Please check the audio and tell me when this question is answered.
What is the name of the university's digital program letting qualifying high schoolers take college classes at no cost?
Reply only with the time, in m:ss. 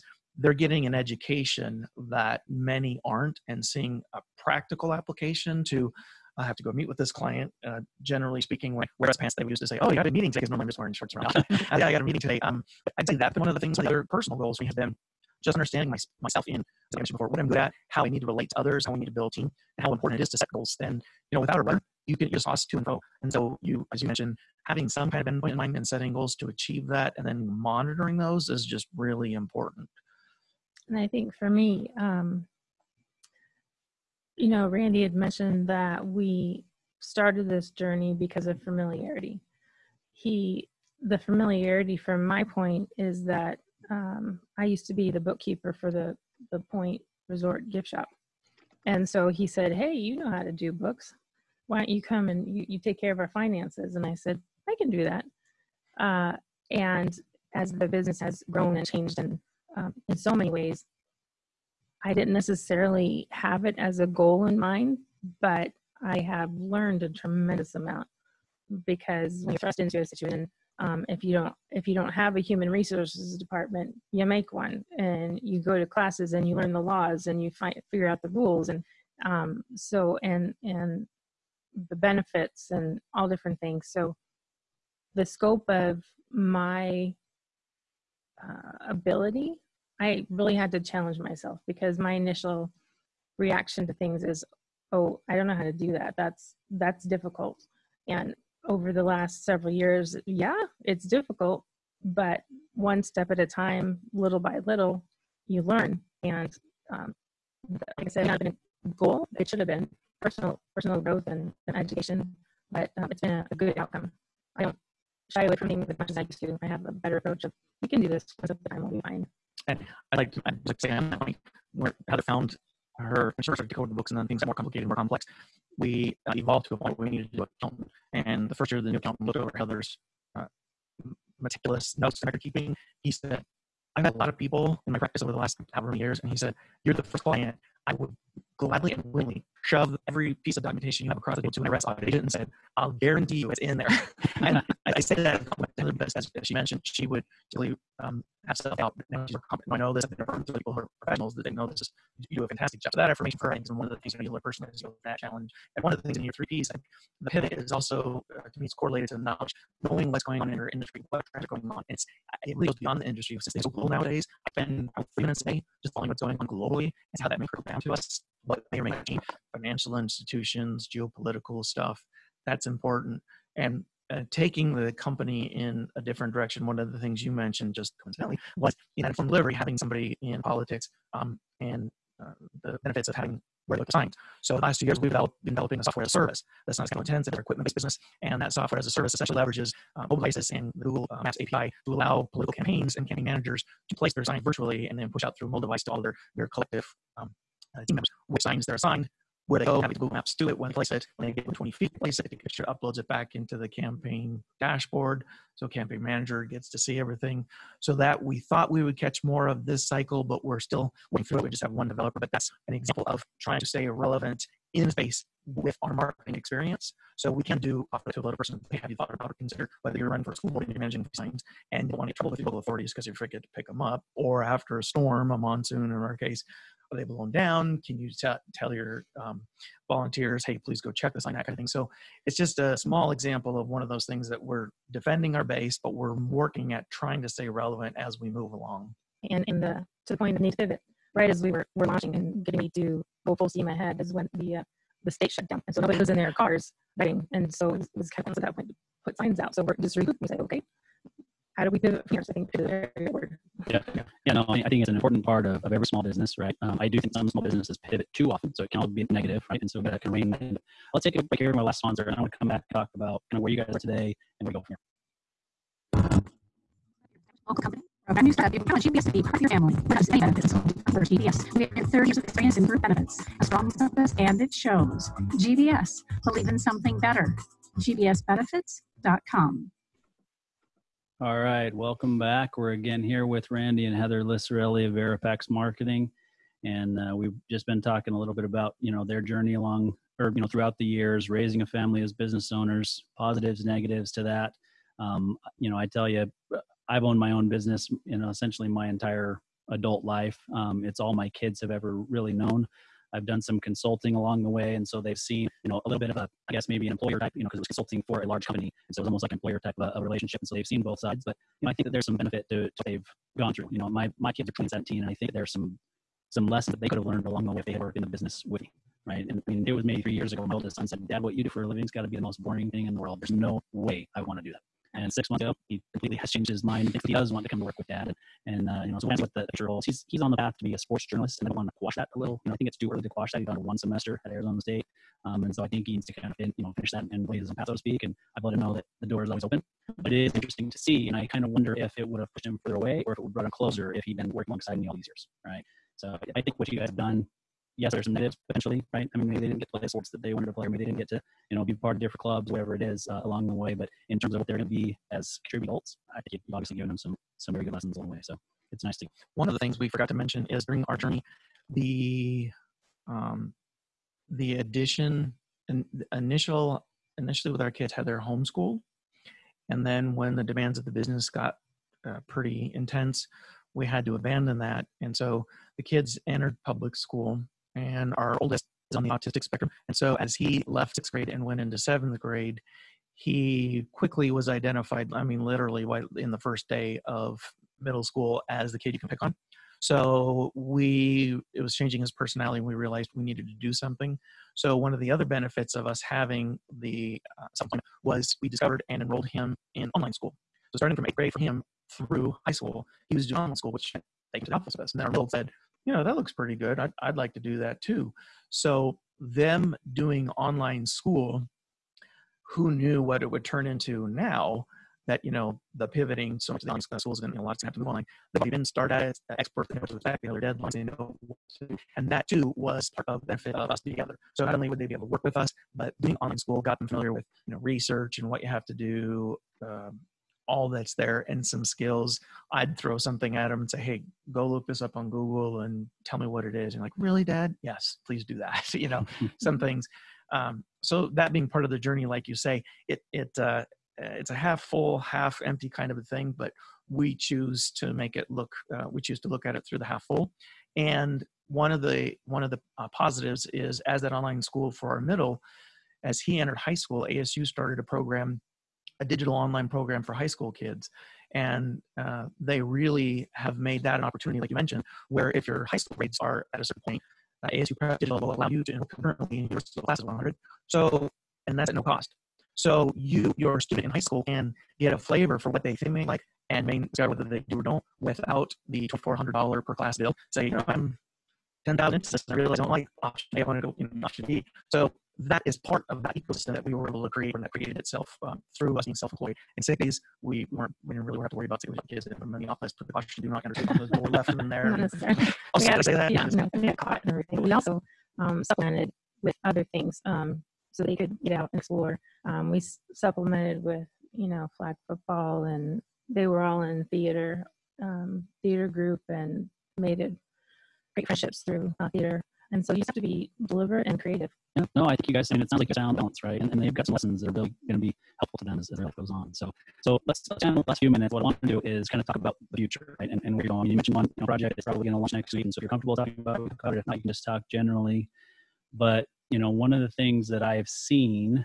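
7:47.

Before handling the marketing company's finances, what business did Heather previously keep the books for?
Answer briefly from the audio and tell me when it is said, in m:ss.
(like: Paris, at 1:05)
the Point Resort gift shop, at 0:46.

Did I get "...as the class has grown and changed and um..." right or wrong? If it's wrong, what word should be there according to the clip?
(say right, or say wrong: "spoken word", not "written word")
wrong: "business", not "class".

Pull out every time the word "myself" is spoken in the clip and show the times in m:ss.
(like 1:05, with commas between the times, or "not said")
0:16, 1:31.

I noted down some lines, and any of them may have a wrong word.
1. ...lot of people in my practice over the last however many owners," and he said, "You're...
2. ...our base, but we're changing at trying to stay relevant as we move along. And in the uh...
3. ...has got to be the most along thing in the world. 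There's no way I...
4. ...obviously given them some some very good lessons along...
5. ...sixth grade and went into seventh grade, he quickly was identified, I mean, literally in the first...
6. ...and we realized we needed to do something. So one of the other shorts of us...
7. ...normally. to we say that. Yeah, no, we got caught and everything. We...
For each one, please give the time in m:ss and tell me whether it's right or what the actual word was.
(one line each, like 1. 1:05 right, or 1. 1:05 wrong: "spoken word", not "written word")
1. 2:14 wrong: "years", not "owners"
2. 3:55 wrong: "working", not "changing"
3. 5:21 wrong: "boring", not "along"
4. 5:56 right
5. 6:20 right
6. 6:32 wrong: "benefits", not "shorts"
7. 8:14 wrong: "necessarily", not "normally".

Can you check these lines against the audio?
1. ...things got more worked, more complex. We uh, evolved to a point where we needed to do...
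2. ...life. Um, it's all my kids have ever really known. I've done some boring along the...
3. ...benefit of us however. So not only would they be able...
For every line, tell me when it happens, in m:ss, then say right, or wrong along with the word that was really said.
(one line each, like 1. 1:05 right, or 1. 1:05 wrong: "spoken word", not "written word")
1. 2:04 wrong: "complicated", not "worked"
2. 5:00 wrong: "consulting", not "boring"
3. 7:03 wrong: "together", not "however".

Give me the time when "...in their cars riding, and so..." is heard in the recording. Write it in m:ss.
4:06.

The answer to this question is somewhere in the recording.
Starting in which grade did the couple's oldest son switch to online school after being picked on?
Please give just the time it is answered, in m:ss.
6:41.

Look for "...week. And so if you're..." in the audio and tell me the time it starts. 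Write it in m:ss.
8:45.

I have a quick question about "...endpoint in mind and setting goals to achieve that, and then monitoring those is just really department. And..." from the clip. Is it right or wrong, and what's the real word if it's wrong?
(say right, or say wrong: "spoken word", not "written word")
wrong: "important", not "department".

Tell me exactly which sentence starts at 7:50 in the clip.
So, and that's at no cost.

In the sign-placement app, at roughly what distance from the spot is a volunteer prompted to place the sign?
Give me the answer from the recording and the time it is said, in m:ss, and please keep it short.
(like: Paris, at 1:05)
20 feet, at 3:21.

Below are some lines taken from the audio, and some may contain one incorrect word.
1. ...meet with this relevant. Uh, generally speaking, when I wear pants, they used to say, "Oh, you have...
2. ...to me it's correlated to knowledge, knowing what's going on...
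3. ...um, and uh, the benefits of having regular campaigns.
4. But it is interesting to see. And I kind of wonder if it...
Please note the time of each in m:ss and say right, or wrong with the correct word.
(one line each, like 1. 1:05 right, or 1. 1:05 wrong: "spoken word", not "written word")
1. 0:06 wrong: "client", not "relevant"
2. 2:38 right
3. 3:01 wrong: "signs", not "campaigns"
4. 5:39 right.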